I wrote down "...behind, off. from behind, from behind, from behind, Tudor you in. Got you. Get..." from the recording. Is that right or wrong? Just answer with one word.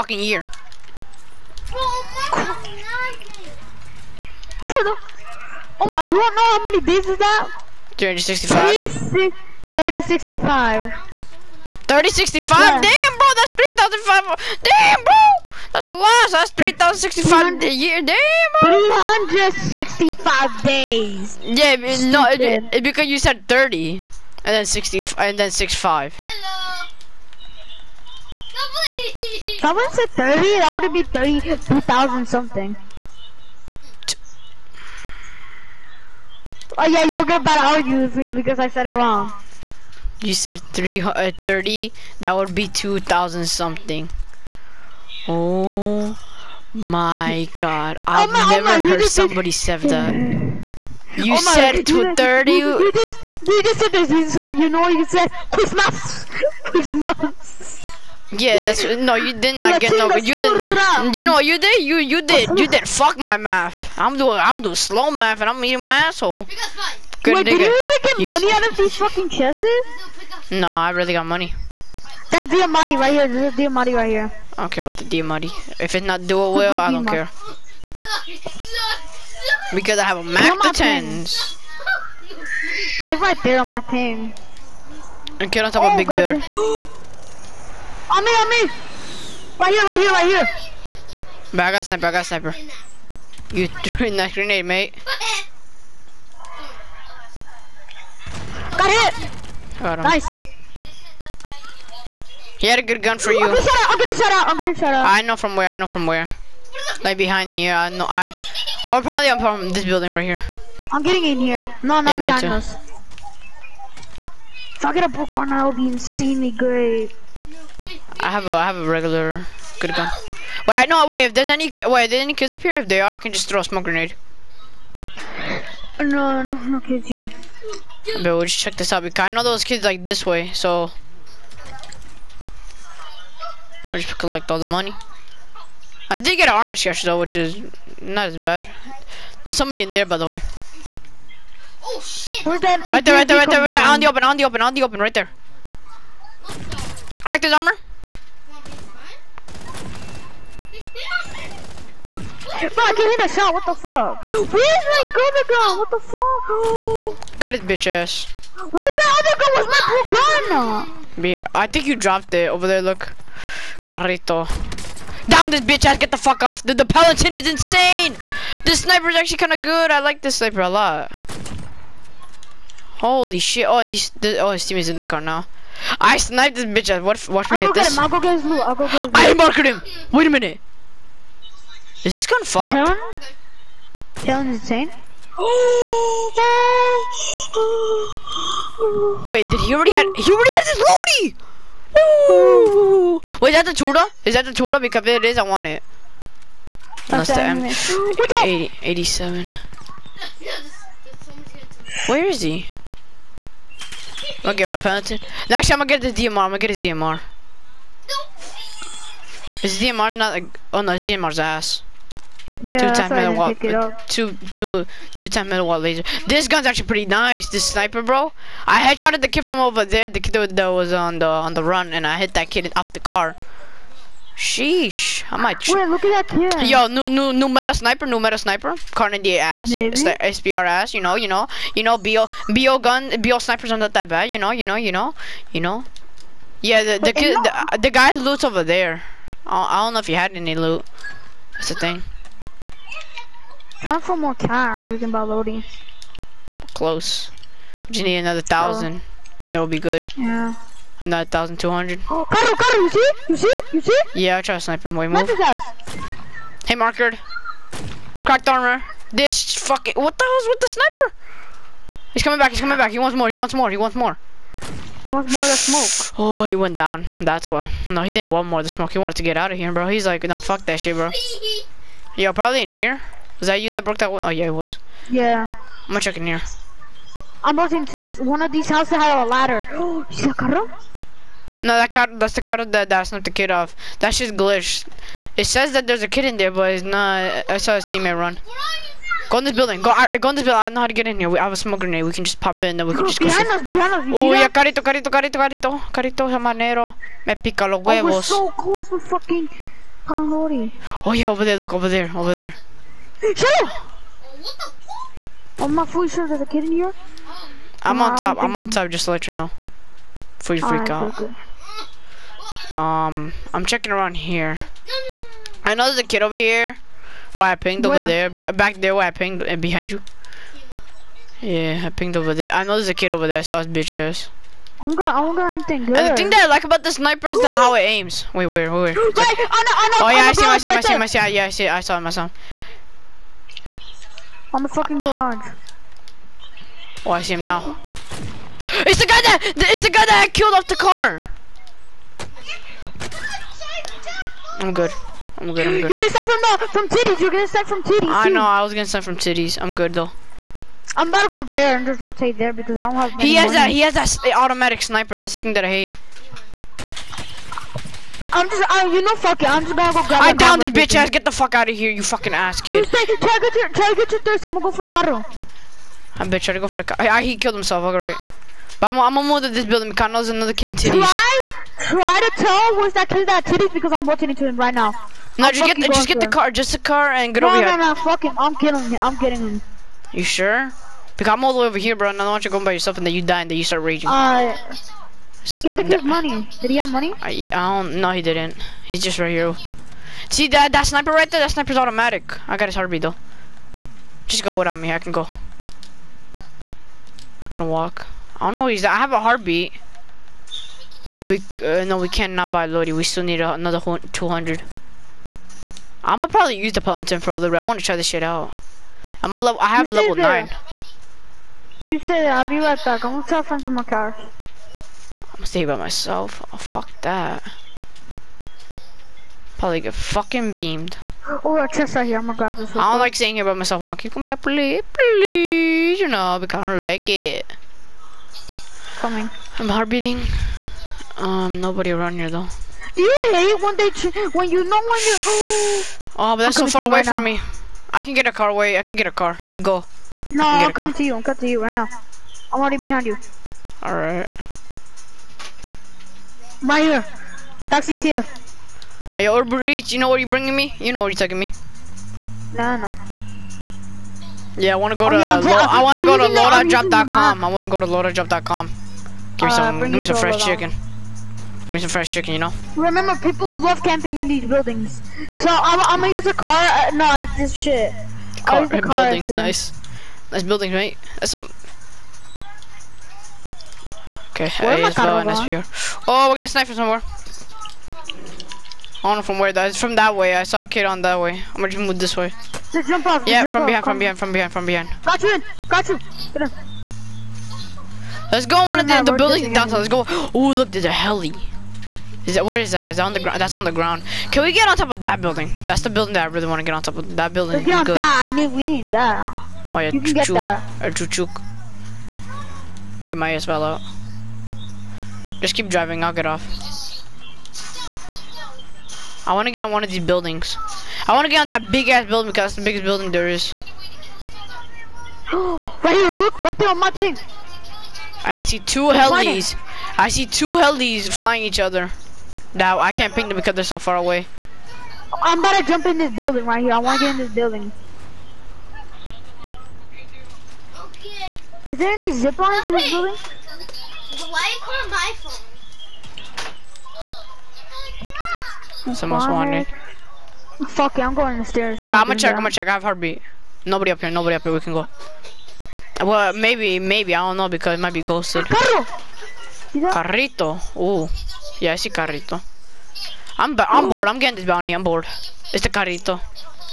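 wrong.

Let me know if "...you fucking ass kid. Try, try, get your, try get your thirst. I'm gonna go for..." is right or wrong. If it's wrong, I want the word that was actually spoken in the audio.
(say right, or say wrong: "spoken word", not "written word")
right.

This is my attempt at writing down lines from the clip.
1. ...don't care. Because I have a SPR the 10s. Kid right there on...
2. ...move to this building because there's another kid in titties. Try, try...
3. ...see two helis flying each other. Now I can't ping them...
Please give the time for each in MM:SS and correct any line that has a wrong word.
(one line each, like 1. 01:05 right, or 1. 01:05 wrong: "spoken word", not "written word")
1. 01:16 wrong: "Mac", not "SPR"
2. 06:09 right
3. 08:40 right.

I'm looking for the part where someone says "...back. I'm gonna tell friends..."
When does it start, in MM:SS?
06:52.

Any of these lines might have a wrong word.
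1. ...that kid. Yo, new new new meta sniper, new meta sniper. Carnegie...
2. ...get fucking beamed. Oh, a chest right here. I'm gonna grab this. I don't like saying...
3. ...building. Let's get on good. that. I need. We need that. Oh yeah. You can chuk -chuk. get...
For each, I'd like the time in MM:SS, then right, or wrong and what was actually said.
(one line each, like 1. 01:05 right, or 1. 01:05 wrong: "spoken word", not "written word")
1. 03:46 right
2. 06:59 right
3. 08:17 right.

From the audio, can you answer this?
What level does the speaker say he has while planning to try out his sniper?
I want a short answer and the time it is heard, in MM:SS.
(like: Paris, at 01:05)
9, at 06:49.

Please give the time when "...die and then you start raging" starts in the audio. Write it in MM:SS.
06:23.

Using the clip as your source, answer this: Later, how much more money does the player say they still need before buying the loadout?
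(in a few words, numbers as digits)
200.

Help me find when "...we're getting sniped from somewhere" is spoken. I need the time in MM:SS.
07:56.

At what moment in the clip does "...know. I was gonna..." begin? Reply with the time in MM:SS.
05:48.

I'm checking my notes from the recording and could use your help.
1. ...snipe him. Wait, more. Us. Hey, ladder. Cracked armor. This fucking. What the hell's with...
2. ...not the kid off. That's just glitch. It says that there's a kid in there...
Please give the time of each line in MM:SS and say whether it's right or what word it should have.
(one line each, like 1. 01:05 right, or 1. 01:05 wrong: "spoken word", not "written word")
1. 04:14 wrong: "marker", not "ladder"
2. 04:43 right.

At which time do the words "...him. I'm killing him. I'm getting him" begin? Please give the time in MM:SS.
06:18.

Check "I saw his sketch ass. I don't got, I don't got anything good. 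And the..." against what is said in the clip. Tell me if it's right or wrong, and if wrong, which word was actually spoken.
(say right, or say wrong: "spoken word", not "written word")
wrong: "bitch", not "sketch".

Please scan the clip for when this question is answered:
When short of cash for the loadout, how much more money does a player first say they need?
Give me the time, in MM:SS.
04:07.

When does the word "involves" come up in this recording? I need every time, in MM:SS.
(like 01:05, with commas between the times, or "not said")
not said.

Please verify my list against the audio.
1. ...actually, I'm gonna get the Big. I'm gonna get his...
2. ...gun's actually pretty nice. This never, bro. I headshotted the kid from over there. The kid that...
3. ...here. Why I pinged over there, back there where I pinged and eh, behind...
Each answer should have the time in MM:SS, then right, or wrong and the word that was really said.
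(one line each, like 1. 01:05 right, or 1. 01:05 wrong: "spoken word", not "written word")
1. 03:25 wrong: "DMR", not "Big"
2. 03:36 wrong: "sniper", not "never"
3. 05:16 right.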